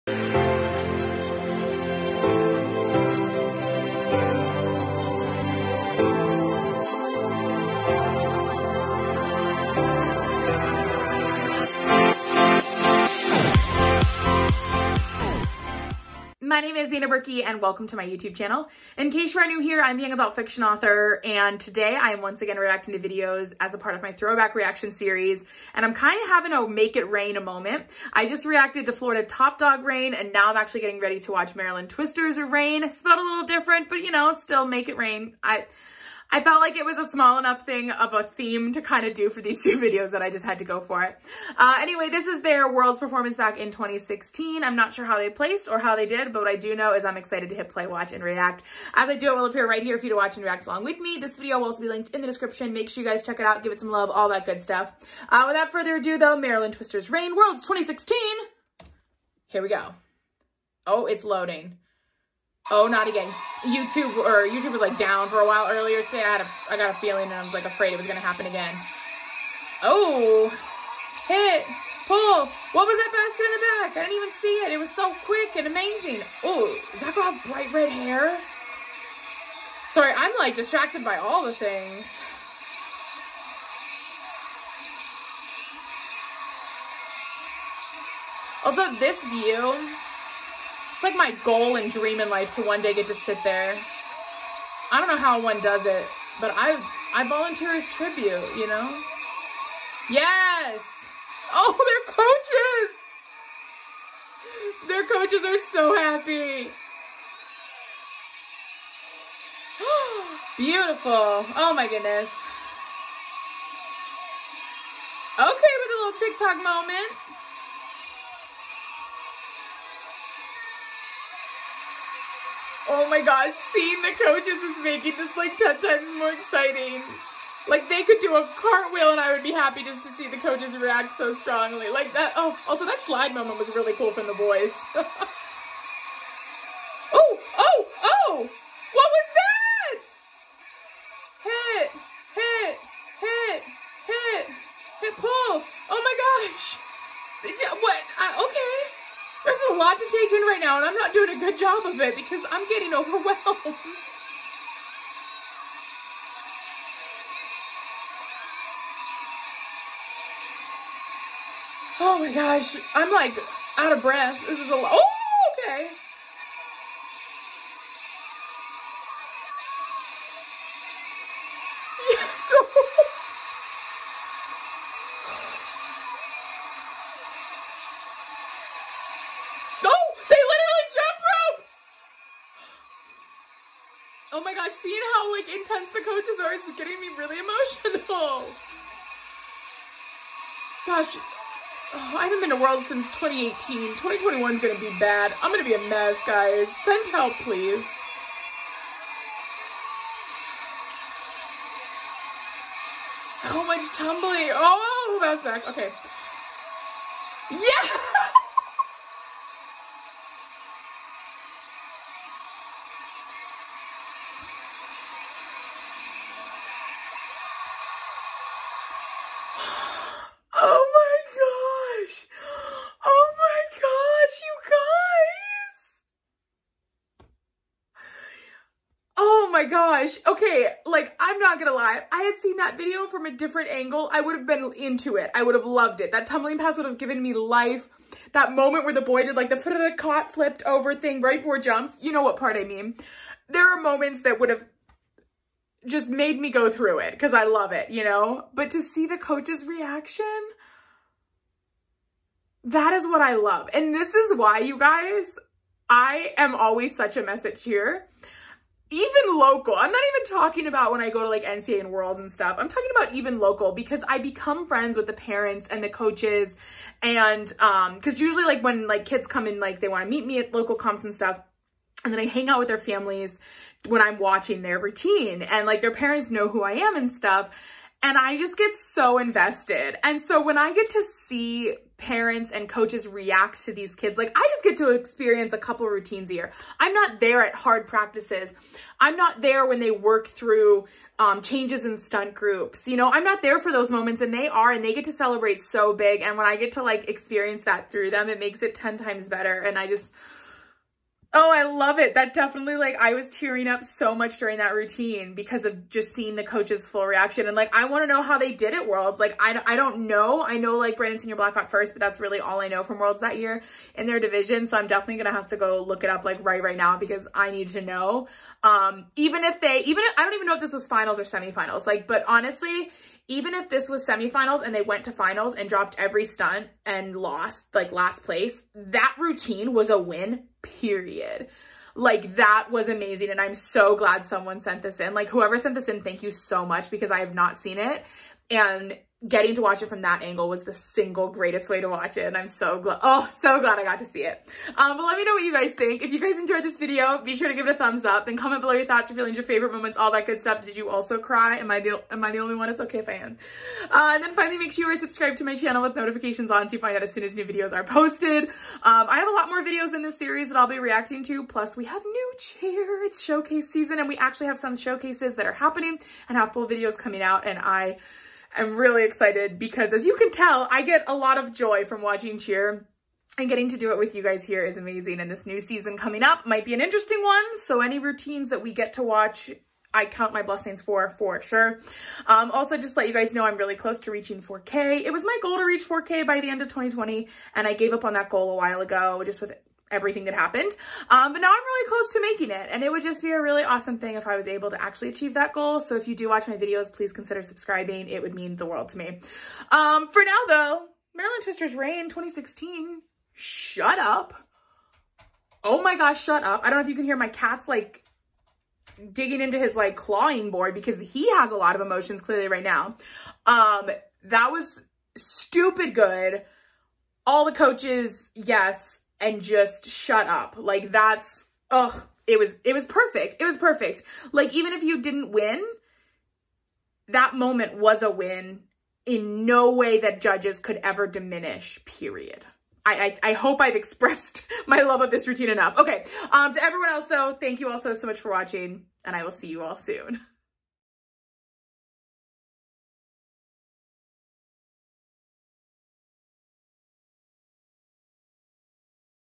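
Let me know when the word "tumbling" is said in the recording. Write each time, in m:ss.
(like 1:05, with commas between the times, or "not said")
3:23, 3:56.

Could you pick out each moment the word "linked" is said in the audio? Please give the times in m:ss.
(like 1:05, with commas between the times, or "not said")
0:51.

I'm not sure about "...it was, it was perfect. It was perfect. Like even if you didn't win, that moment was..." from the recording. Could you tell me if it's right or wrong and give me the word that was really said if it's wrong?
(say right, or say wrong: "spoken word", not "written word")
right.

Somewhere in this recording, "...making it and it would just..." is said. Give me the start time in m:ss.
6:32.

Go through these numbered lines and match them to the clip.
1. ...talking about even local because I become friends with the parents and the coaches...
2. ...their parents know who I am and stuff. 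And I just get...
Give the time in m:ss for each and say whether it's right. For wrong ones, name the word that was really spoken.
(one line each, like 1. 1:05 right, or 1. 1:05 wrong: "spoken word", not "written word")
1. 4:22 right
2. 4:35 right.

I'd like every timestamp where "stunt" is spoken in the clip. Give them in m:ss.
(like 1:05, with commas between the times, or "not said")
4:52, 5:26.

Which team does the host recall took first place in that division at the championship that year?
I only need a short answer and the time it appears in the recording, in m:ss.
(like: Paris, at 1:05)
Brandon Senior Blackhawk, at 5:10.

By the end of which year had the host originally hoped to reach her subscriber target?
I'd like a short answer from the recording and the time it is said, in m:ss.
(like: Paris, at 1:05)
2020, at 6:26.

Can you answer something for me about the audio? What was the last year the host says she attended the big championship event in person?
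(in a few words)
2018.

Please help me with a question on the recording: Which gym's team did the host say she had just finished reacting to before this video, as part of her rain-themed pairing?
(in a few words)
Florida Top Dog.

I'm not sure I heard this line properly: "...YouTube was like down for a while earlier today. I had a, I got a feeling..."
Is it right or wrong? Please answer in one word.
right.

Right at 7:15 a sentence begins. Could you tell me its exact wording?
Okay, um, to everyone else though, thank you all so, so much for watching and I will see you all soon.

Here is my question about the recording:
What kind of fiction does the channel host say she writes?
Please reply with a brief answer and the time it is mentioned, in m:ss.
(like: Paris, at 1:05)
Young adult fiction, at 0:20.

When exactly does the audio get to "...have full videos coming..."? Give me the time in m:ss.
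6:06.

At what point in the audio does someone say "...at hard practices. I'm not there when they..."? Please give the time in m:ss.
4:47.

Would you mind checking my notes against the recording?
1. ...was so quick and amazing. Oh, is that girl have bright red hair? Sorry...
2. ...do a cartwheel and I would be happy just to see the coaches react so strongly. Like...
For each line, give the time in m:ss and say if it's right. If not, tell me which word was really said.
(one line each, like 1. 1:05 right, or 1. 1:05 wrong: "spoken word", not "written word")
1. 1:14 right
2. 2:08 right.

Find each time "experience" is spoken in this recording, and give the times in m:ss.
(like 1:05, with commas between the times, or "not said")
4:44, 4:57.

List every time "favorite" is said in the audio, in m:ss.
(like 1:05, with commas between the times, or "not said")
5:49.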